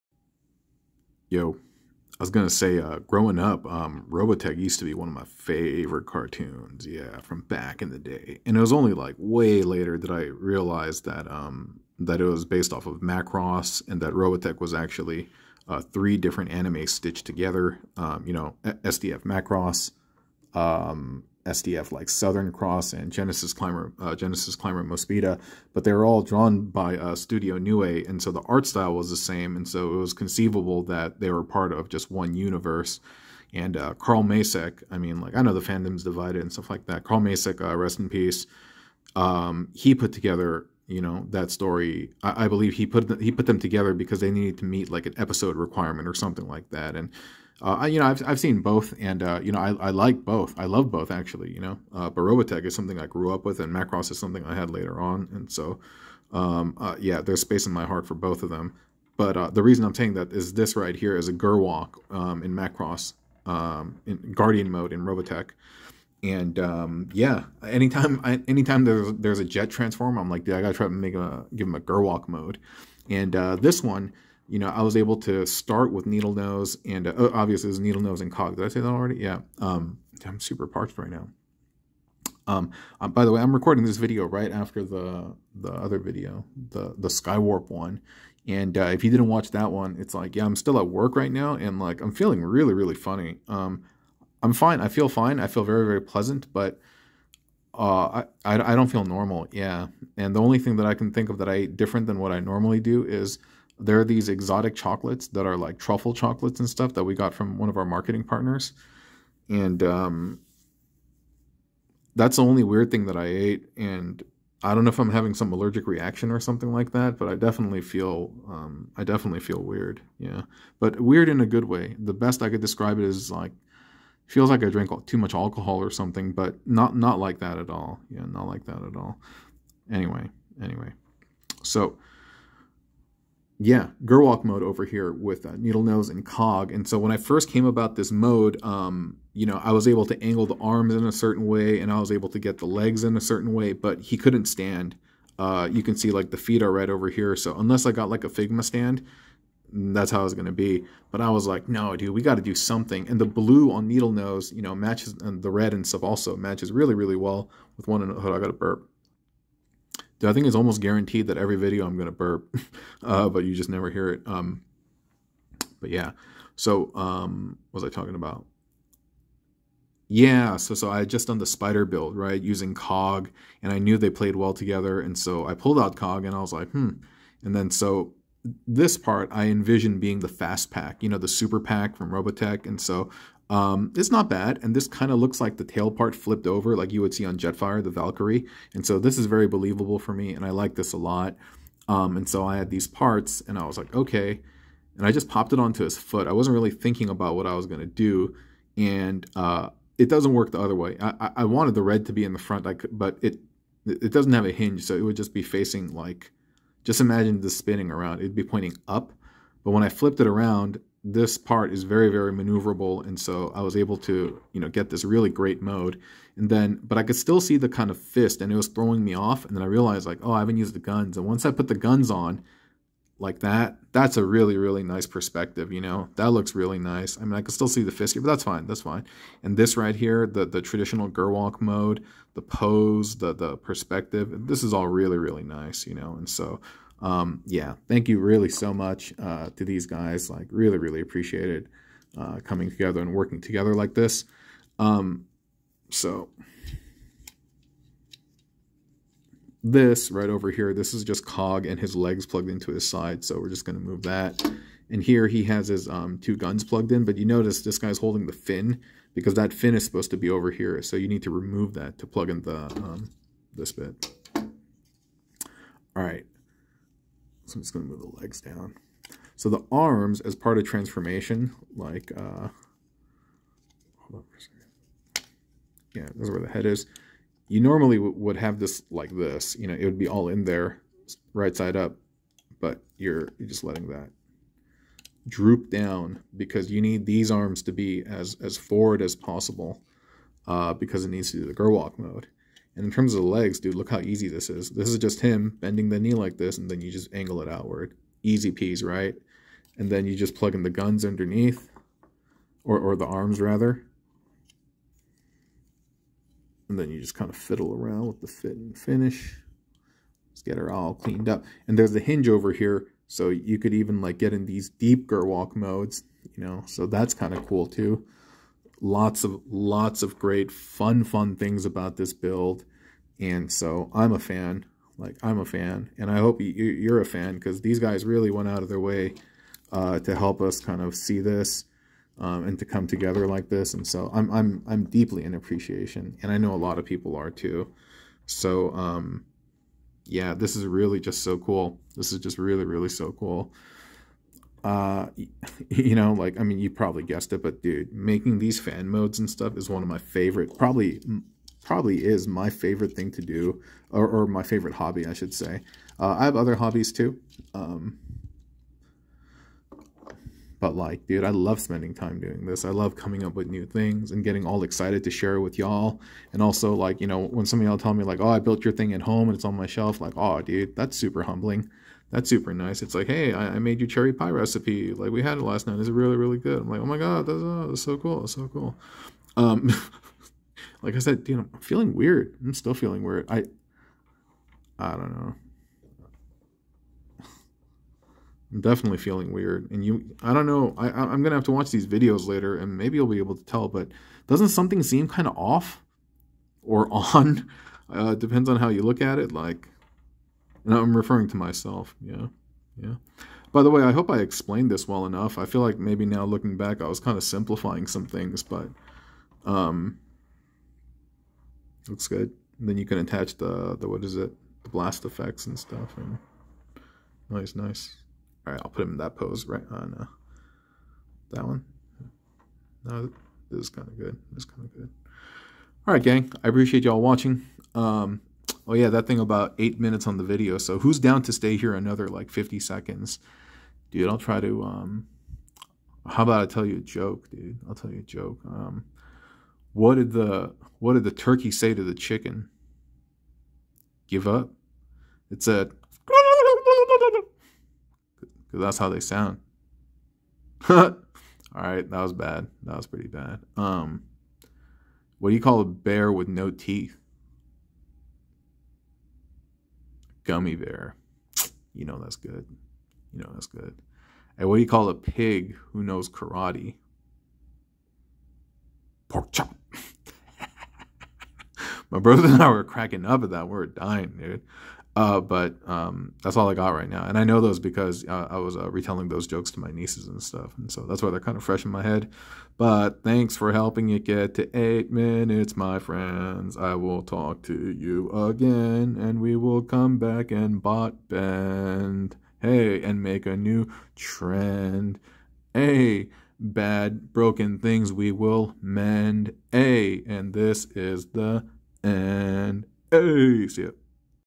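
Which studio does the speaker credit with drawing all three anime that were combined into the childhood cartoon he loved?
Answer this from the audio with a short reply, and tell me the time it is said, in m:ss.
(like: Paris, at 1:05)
Studio Nue, at 0:27.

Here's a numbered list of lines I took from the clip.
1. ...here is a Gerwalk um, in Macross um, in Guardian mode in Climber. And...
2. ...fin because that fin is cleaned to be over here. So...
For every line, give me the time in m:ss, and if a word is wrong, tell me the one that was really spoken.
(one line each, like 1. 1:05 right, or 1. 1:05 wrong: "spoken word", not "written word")
1. 1:00 wrong: "Robotech", not "Climber"
2. 4:18 wrong: "supposed", not "cleaned".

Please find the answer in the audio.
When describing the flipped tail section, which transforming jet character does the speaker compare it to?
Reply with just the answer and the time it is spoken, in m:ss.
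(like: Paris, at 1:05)
Jetfire, at 3:07.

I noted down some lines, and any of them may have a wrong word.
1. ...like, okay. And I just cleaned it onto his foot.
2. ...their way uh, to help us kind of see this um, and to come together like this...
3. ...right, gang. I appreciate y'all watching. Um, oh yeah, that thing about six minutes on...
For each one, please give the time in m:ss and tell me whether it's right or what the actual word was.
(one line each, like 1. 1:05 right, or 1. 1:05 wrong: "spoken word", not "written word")
1. 3:13 wrong: "popped", not "cleaned"
2. 5:28 right
3. 7:05 wrong: "eight", not "six".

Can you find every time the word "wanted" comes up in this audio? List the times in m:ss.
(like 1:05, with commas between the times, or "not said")
3:21.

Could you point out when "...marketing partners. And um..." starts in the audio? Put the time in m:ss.
1:47.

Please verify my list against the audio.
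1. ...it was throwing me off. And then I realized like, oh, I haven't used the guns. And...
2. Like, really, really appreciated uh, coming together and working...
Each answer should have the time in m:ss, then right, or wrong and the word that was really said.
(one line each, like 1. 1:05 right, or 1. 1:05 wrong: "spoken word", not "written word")
1. 3:38 right
2. 4:00 right.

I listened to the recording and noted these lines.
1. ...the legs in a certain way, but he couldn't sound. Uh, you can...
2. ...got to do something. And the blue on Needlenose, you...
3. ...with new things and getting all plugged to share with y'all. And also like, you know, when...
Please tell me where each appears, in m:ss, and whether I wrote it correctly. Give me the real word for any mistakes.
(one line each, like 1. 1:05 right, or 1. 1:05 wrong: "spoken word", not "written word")
1. 2:22 wrong: "stand", not "sound"
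2. 2:32 right
3. 6:03 wrong: "excited", not "plugged".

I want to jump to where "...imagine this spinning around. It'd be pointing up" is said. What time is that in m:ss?
3:27.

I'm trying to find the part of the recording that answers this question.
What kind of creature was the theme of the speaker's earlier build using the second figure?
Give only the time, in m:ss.
2:51.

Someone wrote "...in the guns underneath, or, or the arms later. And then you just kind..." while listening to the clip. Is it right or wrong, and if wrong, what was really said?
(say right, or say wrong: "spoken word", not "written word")
wrong: "rather", not "later".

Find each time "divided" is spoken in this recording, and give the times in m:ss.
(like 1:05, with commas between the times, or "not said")
0:36.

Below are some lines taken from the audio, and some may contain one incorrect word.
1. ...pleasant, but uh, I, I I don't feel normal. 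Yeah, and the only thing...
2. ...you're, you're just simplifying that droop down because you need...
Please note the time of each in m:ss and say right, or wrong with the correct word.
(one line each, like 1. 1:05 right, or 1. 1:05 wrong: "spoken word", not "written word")
1. 1:36 right
2. 4:42 wrong: "letting", not "simplifying".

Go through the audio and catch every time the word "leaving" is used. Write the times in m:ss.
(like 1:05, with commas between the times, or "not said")
not said.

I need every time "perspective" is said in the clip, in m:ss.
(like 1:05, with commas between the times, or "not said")
3:45, 3:53.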